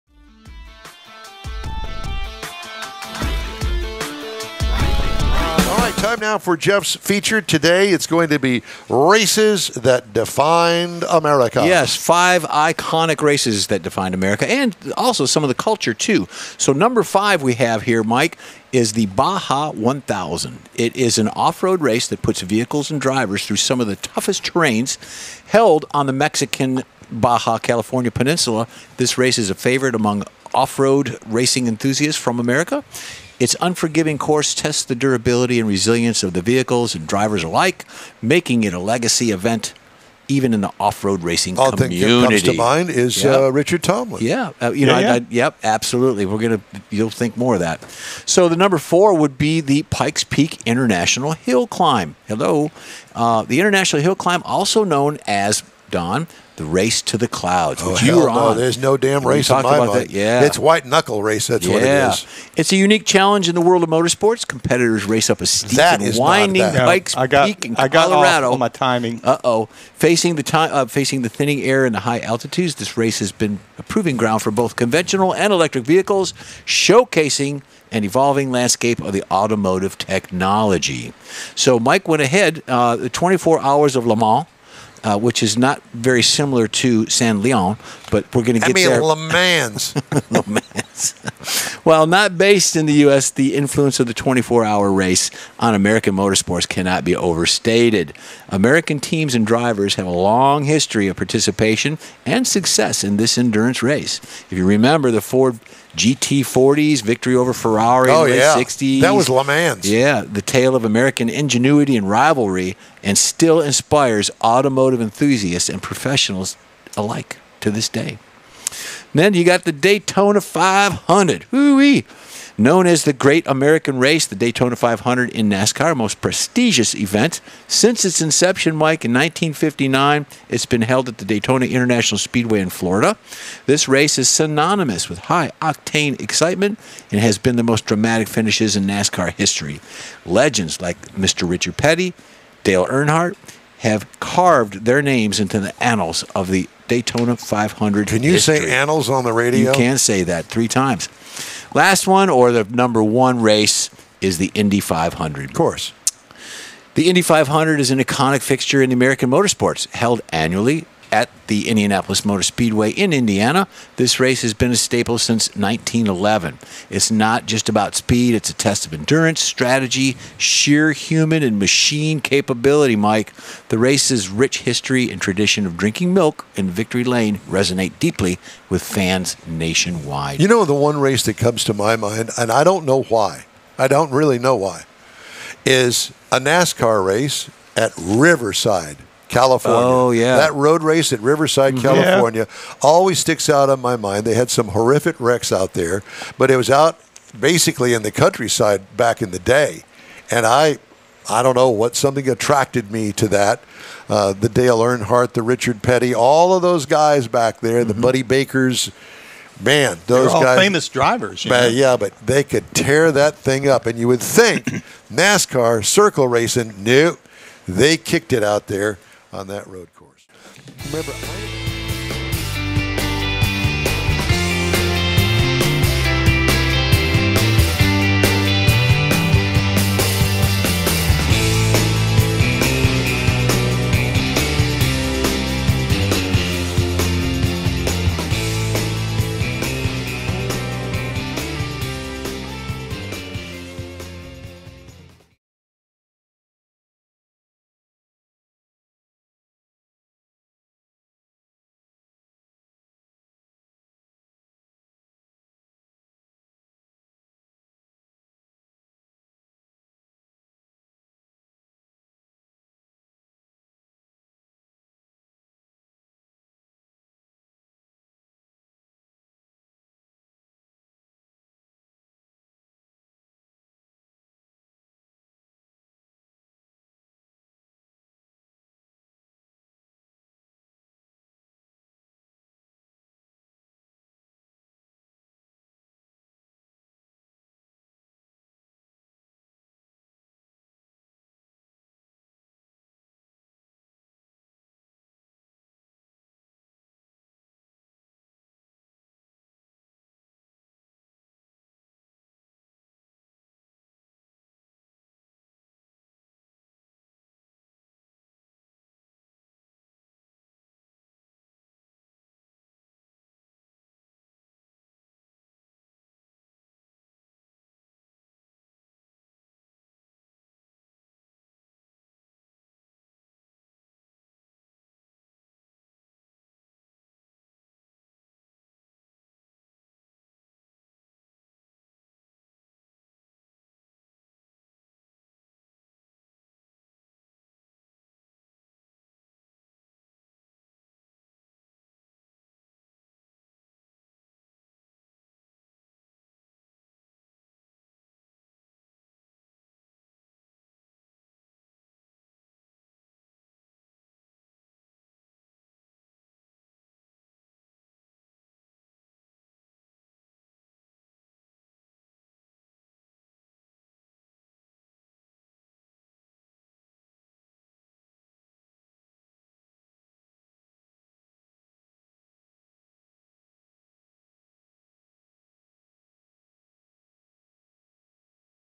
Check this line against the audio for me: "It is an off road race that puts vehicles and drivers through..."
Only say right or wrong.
right.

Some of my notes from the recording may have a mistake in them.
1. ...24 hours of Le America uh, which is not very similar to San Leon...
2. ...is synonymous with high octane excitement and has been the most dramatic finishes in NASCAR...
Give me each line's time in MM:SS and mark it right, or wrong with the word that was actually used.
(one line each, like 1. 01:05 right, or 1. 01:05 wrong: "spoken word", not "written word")
1. 01:23 wrong: "Mans", not "America"
2. 02:14 right.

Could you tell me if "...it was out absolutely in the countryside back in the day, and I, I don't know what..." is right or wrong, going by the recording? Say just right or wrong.
wrong.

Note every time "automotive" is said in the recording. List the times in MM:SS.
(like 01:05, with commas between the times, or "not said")
01:19, 01:54.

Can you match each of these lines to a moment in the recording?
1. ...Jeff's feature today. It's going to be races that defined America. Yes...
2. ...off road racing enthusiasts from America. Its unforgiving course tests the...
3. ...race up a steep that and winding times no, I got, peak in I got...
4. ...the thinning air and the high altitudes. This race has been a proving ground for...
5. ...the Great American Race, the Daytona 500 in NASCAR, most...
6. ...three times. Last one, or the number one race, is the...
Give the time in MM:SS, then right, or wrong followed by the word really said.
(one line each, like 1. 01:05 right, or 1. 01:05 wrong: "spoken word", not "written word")
1. 00:06 right
2. 00:30 right
3. 01:05 wrong: "bikes", not "times"
4. 01:11 right
5. 02:03 right
6. 02:30 right.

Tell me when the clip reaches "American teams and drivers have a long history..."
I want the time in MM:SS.
01:38.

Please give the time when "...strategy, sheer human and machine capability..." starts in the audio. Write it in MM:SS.
02:49.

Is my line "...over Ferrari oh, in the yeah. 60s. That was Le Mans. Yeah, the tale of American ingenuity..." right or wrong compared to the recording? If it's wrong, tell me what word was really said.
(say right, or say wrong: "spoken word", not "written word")
right.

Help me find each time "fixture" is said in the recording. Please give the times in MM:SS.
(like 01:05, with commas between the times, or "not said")
02:38.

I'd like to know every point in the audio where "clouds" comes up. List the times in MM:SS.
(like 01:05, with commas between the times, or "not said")
00:57.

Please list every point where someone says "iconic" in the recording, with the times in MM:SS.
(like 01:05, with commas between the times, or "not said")
00:12, 02:37.